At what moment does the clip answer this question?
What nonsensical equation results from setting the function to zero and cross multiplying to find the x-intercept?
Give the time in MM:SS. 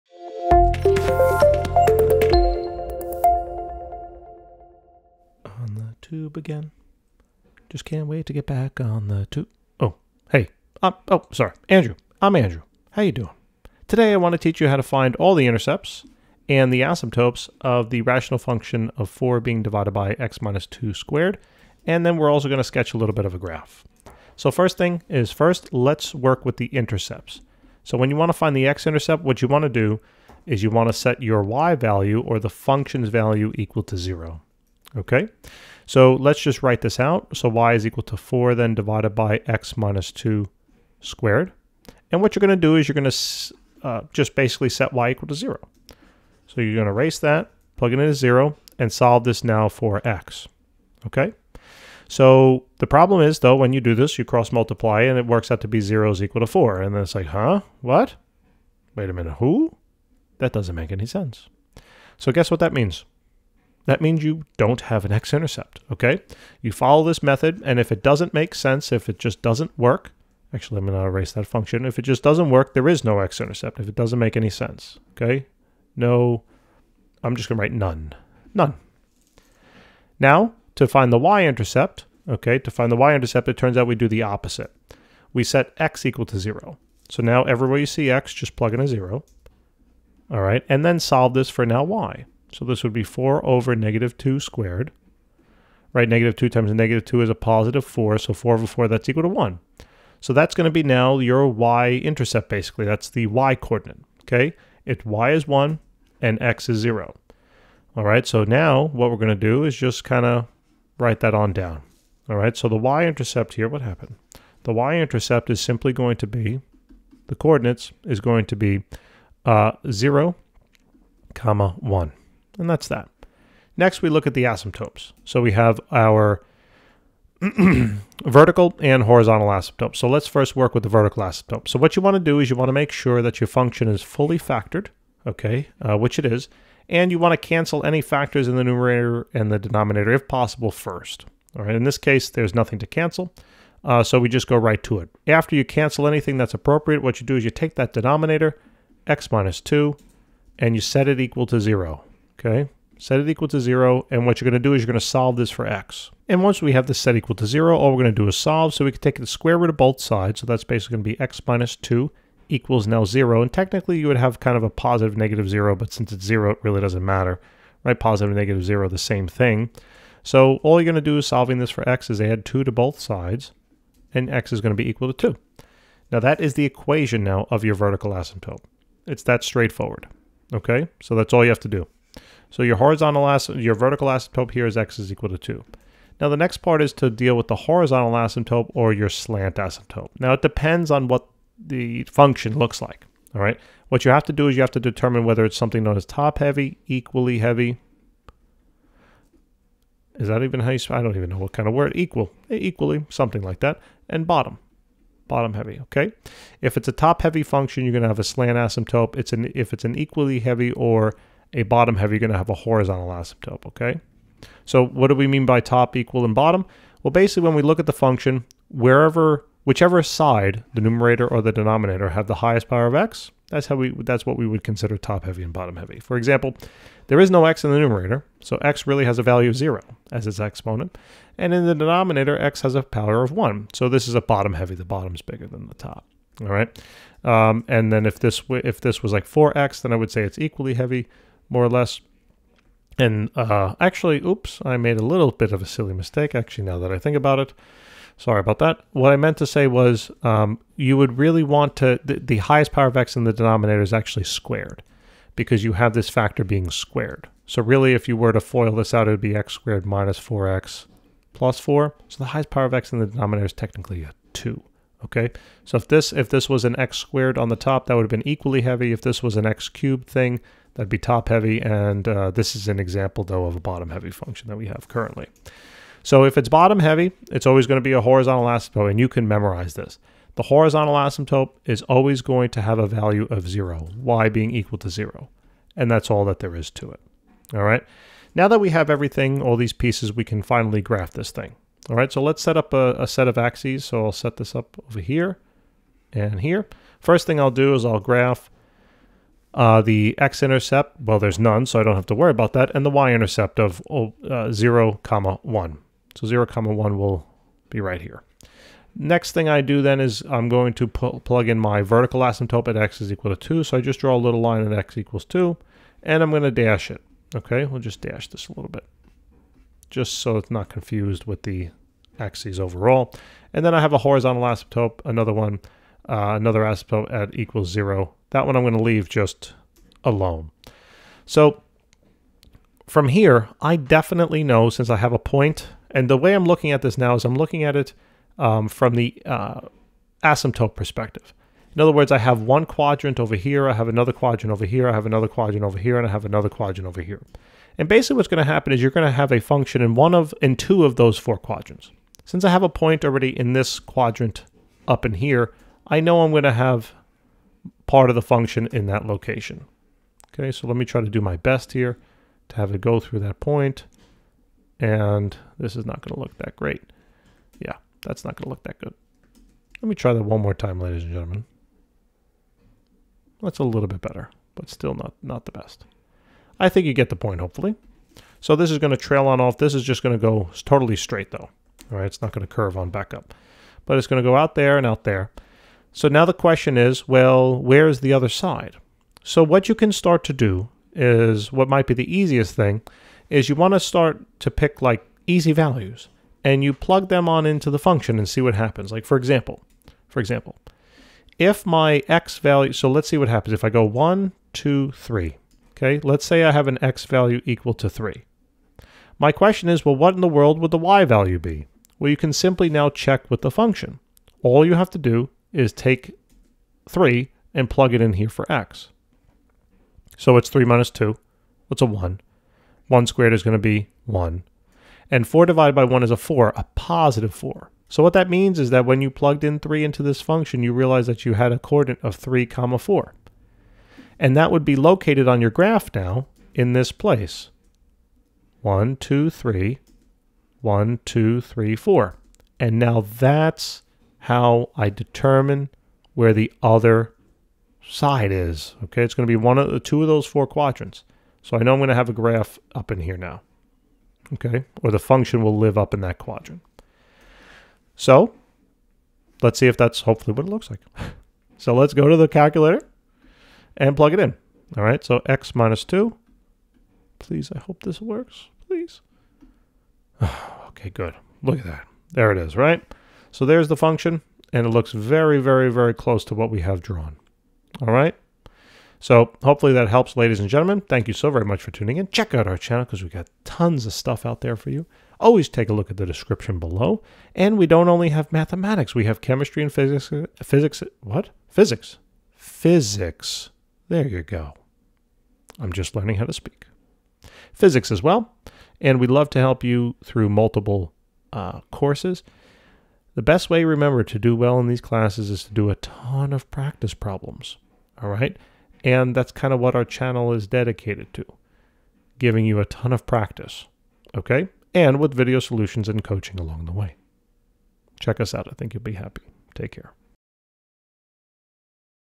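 00:55.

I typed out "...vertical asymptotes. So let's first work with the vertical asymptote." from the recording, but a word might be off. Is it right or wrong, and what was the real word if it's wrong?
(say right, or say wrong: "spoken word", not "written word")
wrong: "horizontal", not "vertical".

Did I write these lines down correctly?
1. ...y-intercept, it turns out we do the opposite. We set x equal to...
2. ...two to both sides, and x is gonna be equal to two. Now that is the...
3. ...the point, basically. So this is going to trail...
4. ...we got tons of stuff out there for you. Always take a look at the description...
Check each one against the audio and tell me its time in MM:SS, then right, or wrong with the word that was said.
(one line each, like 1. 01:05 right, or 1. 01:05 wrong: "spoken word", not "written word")
1. 01:22 right
2. 02:52 right
3. 06:17 wrong: "hopefully", not "basically"
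4. 08:03 right.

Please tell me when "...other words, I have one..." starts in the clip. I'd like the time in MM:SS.
05:41.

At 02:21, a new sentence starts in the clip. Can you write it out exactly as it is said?
All right, in this case, there's nothing to cancel, uh, so we just go right to it.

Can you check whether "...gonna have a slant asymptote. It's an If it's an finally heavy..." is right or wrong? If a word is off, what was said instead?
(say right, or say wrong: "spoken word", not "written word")
wrong: "equally", not "finally".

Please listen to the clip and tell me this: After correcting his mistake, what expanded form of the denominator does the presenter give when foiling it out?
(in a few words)
x^2 - 4x + 4.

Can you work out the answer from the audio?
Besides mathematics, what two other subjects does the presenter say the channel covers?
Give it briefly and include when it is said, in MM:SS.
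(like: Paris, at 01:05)
chemistry and physics, at 08:09.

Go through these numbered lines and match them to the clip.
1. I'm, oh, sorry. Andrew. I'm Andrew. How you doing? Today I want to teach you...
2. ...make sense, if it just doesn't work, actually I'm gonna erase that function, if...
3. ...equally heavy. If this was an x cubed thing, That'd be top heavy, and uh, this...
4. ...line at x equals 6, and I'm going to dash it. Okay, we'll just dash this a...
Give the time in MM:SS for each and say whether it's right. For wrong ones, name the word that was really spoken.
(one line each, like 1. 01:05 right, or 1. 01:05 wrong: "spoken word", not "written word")
1. 00:10 right
2. 01:08 right
3. 04:28 right
4. 05:14 wrong: "2", not "6".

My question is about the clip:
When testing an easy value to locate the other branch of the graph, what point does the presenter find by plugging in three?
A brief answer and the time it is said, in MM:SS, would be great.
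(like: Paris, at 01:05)
(3, 4), at 07:12.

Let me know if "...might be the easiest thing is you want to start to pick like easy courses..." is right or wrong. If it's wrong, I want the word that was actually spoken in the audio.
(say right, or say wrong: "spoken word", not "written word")
wrong: "values", not "courses".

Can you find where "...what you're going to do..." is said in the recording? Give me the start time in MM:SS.
00:42.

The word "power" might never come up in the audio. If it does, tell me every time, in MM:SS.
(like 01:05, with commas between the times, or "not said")
03:42, 03:52, 04:12, 04:22.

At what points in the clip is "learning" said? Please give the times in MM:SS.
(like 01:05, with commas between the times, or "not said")
08:15.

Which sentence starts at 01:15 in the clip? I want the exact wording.
No, I'm just gonna write none, none.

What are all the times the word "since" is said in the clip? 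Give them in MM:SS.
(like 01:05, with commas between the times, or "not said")
02:45, 05:34, 05:52.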